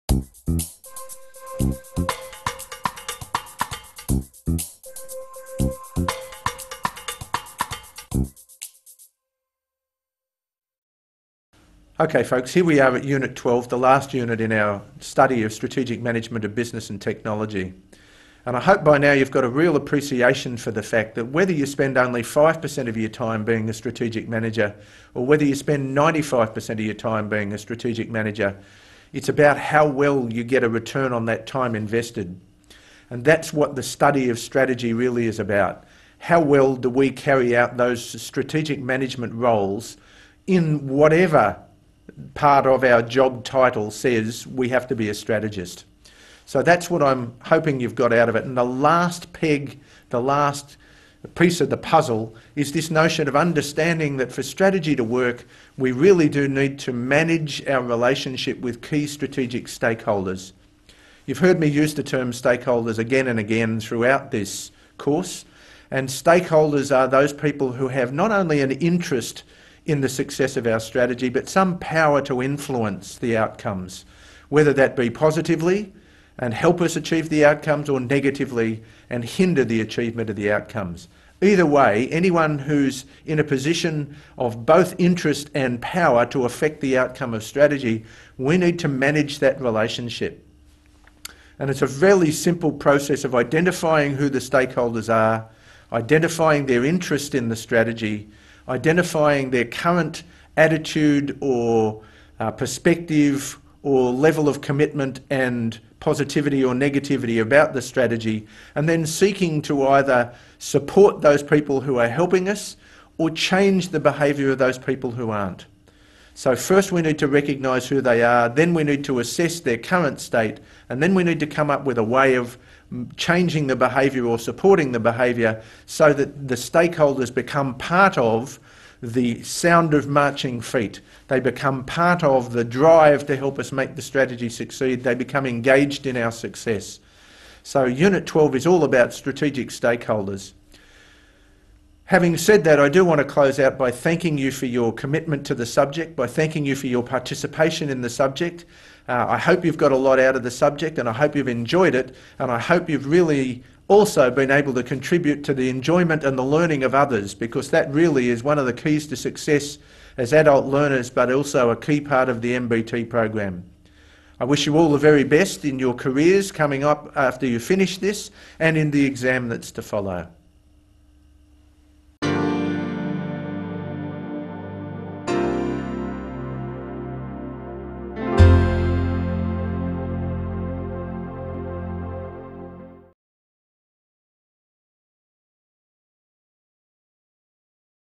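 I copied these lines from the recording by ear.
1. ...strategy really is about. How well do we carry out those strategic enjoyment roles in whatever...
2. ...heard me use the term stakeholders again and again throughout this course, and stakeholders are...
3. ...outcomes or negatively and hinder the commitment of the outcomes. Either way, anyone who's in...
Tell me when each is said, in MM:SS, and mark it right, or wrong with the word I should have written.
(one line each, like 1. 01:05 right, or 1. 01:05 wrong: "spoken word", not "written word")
1. 00:34 wrong: "management", not "enjoyment"
2. 01:01 right
3. 01:17 wrong: "achievement", not "commitment".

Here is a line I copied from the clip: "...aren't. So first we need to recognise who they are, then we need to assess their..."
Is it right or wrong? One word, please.
right.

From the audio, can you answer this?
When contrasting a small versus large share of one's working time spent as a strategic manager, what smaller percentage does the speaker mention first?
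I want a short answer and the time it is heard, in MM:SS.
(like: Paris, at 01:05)
5%, at 00:22.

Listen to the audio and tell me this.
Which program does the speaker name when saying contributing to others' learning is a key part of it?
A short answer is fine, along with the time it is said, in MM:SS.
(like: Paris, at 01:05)
MBT, at 02:42.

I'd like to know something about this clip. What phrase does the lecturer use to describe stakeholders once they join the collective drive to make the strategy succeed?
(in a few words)
the sound of marching feet.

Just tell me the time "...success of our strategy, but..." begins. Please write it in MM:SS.
01:10.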